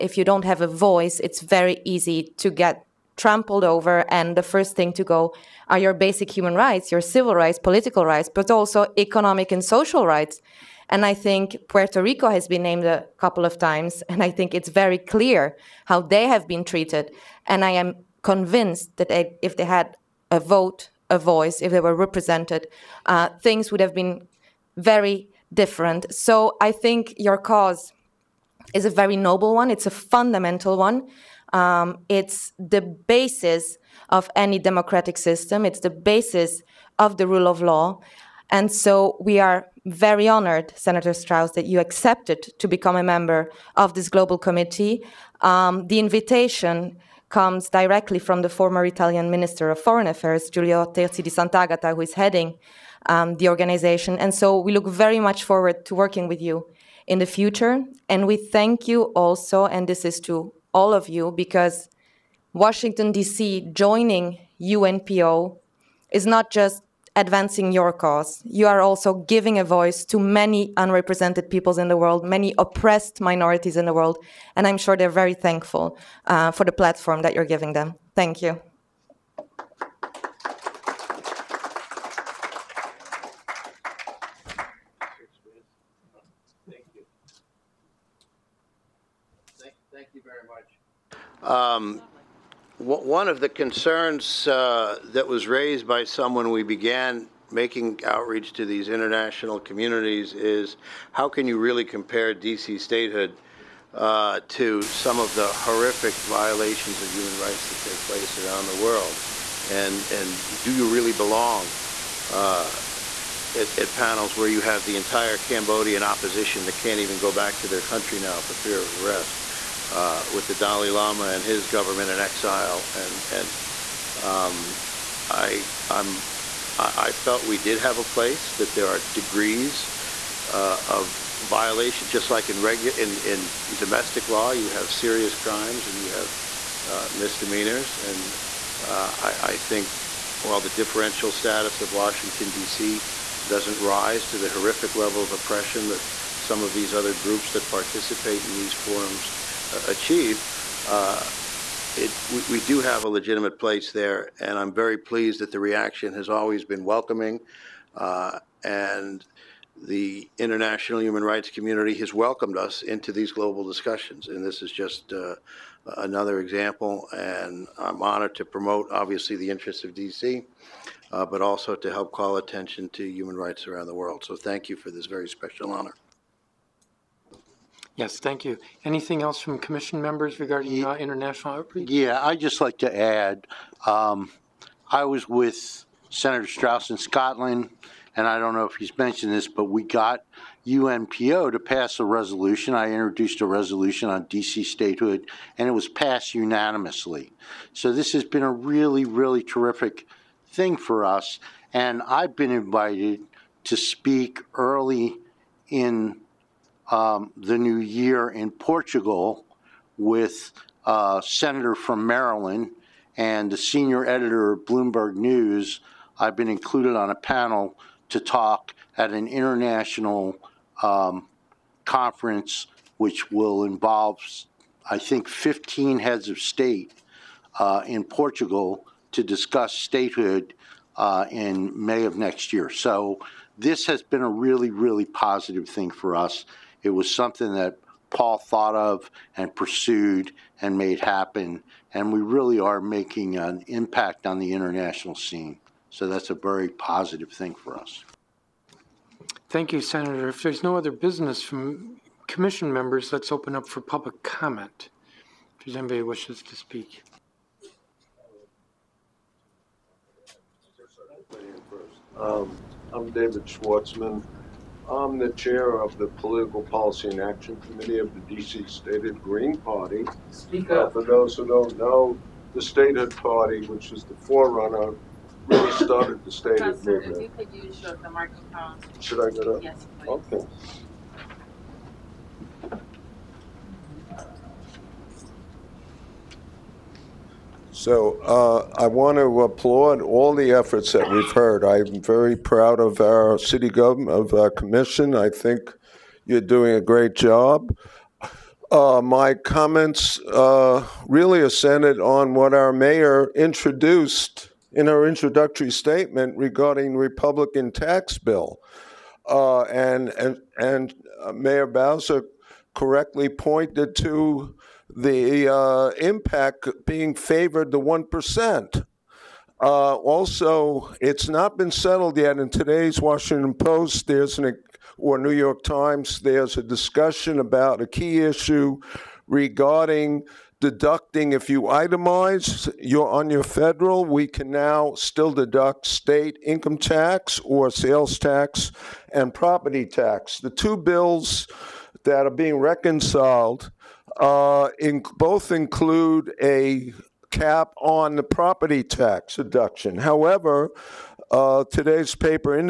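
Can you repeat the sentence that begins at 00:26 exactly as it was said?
So I think your cause is a very noble one.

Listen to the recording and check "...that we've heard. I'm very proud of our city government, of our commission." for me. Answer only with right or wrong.
right.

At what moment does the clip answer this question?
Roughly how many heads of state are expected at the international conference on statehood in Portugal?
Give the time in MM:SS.
03:45.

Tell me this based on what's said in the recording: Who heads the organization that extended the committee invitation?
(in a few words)
Giulio Terzi di Sant'Agata.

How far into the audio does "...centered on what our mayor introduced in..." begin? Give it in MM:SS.
05:01.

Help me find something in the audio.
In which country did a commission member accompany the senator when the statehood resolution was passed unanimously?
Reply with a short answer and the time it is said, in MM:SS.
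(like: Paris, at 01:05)
Scotland, at 03:06.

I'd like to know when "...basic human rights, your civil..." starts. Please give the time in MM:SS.
00:05.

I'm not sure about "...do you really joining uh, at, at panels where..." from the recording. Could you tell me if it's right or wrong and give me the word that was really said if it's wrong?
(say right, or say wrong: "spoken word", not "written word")
wrong: "belong", not "joining".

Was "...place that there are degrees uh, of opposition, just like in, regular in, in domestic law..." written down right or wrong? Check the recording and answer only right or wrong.
wrong.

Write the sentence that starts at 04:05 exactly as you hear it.
So that's a very positive thing for us.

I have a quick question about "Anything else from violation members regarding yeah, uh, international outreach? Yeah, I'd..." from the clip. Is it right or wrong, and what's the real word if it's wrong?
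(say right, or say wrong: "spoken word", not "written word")
wrong: "commission", not "violation".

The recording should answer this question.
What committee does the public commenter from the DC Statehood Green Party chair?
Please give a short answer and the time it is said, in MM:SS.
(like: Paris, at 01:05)
Political Policy and Action Committee, at 04:26.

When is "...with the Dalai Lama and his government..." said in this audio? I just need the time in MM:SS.
02:00.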